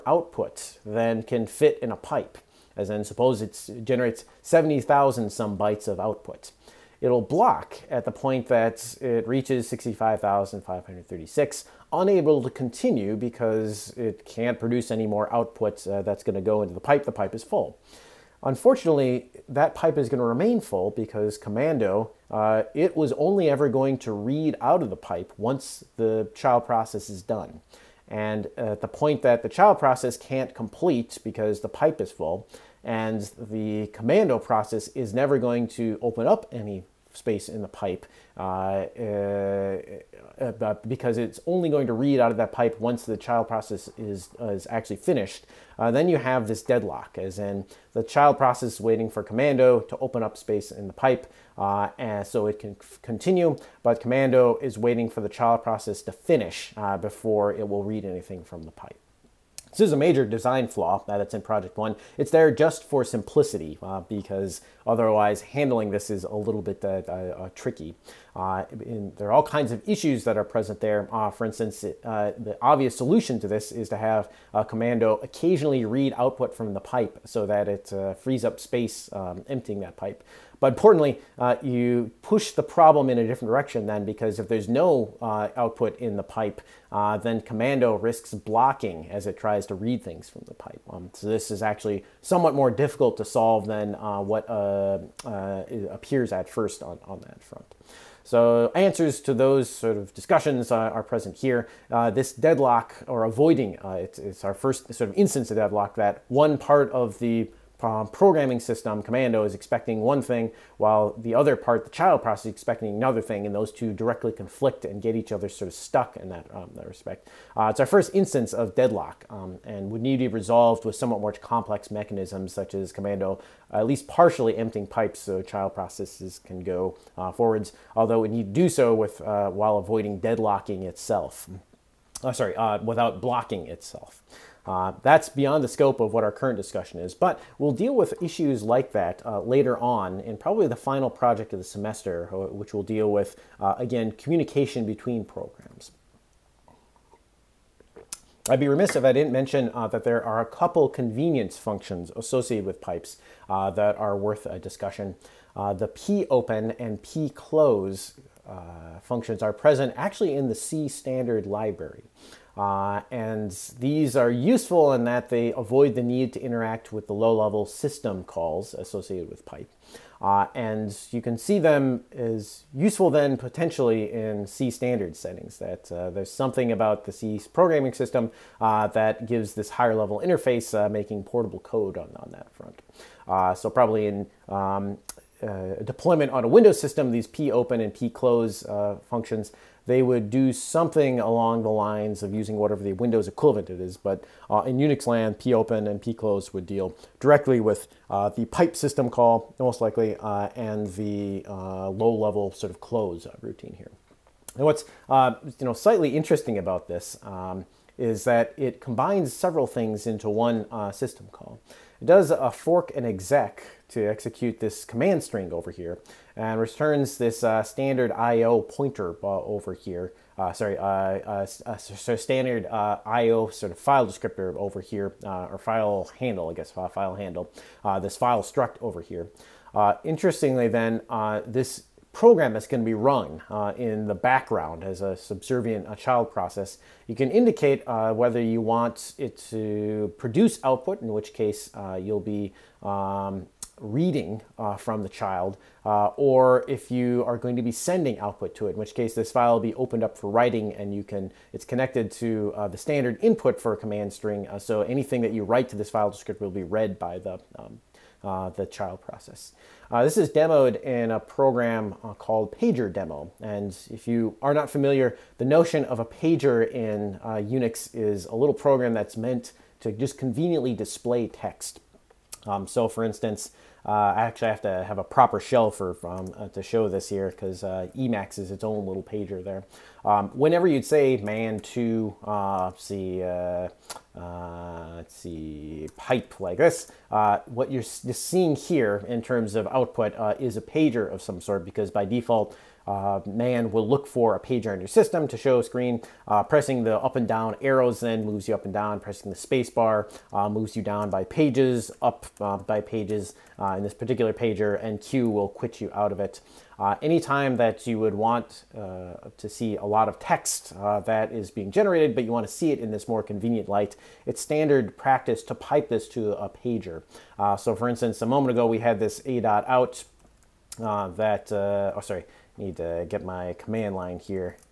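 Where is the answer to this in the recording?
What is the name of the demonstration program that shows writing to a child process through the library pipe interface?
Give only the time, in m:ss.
4:22.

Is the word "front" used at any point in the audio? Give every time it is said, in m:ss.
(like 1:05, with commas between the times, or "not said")
1:37, 3:02.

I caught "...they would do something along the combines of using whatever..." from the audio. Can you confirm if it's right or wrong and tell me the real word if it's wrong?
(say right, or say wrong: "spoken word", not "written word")
wrong: "lines", not "combines".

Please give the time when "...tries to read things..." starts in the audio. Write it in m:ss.
1:29.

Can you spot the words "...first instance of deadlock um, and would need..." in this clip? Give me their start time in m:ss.
1:57.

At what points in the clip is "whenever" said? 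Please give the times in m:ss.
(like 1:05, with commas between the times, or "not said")
4:40.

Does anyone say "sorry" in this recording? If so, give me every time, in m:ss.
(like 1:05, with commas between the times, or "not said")
2:12, 3:40, 5:22.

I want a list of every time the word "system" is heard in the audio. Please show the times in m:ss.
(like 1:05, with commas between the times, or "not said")
1:48, 2:47, 2:57, 3:06, 3:18, 3:30, 4:54.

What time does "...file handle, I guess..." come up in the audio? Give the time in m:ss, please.
3:45.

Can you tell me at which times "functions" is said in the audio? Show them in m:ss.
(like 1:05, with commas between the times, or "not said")
2:31, 2:39, 3:09.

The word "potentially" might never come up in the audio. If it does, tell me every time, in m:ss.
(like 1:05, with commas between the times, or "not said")
2:53.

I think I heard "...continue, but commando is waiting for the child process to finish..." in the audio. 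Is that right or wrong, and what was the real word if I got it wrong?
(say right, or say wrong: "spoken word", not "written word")
right.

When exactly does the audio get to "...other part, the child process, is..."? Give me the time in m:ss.
1:51.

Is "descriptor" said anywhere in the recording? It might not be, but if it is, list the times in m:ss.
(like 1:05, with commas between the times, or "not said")
3:44, 4:16.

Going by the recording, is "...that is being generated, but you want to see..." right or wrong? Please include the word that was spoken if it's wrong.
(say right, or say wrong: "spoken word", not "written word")
right.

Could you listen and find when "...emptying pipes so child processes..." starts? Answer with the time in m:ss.
2:04.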